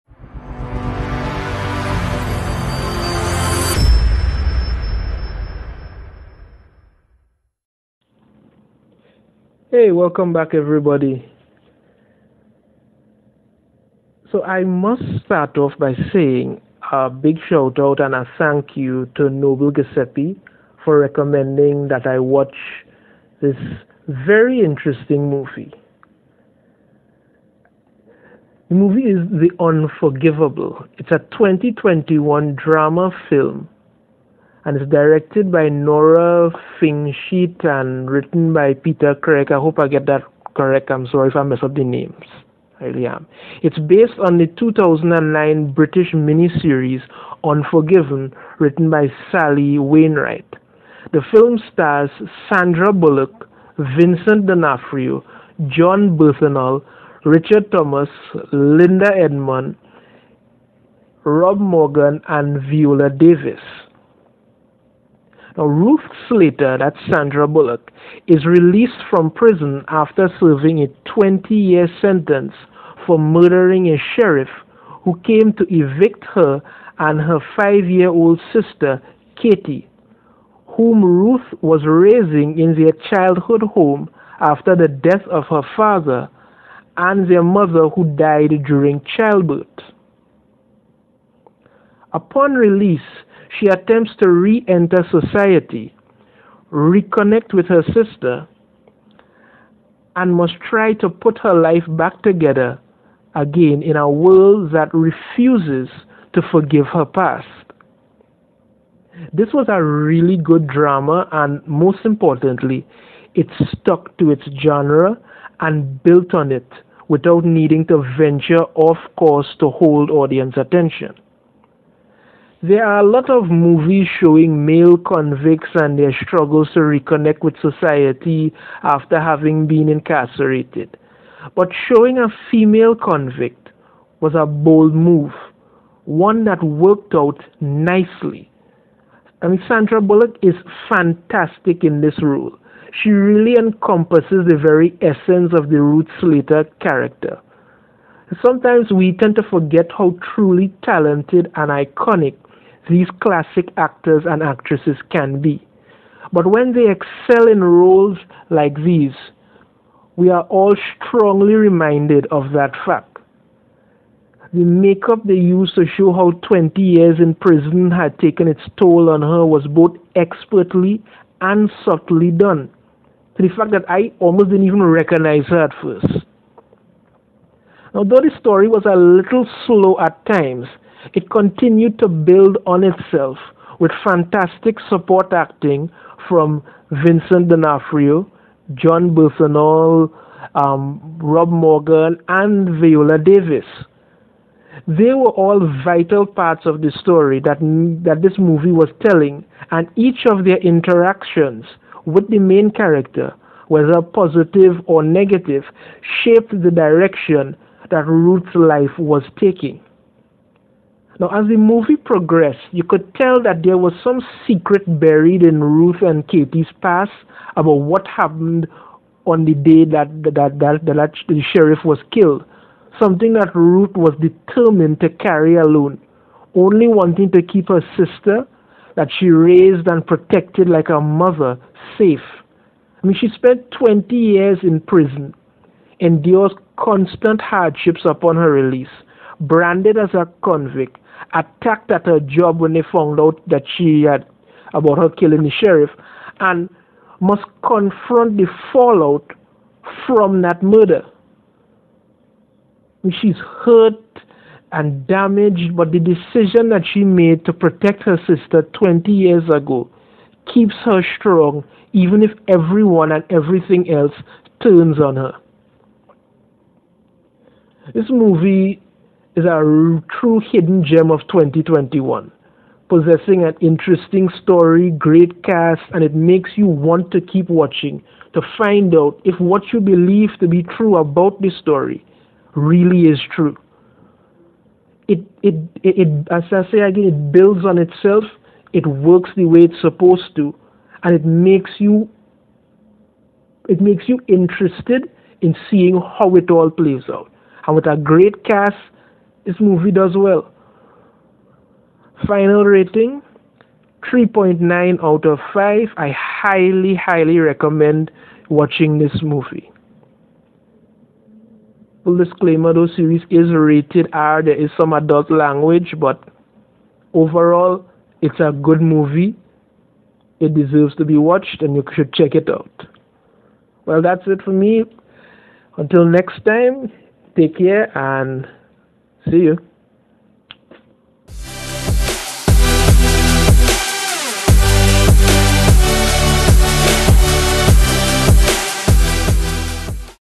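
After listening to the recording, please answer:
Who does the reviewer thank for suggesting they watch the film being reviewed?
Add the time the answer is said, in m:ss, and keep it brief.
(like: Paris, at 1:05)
Noble Giuseppe, at 0:19.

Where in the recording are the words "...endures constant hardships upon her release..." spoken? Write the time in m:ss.
3:55.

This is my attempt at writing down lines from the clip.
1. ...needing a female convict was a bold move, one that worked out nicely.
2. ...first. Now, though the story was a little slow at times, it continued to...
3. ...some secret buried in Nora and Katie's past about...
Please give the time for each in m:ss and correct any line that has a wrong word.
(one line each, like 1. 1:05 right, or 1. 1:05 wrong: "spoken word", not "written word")
1. 2:11 wrong: "showing", not "needing"
2. 2:55 right
3. 3:34 wrong: "Ruth", not "Nora".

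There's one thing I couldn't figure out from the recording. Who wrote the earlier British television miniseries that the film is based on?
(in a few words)
Sally Wainwright.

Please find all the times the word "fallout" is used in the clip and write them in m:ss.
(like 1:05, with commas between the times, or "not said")
4:08.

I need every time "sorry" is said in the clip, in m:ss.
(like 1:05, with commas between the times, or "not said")
0:41.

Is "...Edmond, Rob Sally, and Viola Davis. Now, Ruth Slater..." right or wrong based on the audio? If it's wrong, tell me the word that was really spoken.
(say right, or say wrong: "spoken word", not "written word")
wrong: "Morgan", not "Sally".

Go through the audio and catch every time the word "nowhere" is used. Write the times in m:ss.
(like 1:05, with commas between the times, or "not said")
not said.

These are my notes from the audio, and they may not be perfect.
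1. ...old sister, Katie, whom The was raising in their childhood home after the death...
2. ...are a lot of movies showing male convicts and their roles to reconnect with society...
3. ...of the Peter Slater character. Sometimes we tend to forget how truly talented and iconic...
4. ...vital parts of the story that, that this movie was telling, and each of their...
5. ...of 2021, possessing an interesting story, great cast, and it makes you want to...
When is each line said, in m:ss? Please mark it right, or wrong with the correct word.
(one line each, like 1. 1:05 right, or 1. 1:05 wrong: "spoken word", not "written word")
1. 1:18 wrong: "Ruth", not "The"
2. 2:02 wrong: "struggles", not "roles"
3. 2:25 wrong: "Ruth", not "Peter"
4. 3:15 right
5. 4:31 right.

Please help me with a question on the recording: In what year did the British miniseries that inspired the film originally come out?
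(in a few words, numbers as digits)
2009.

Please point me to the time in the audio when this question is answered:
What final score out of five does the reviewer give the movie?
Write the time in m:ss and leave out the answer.
5:04.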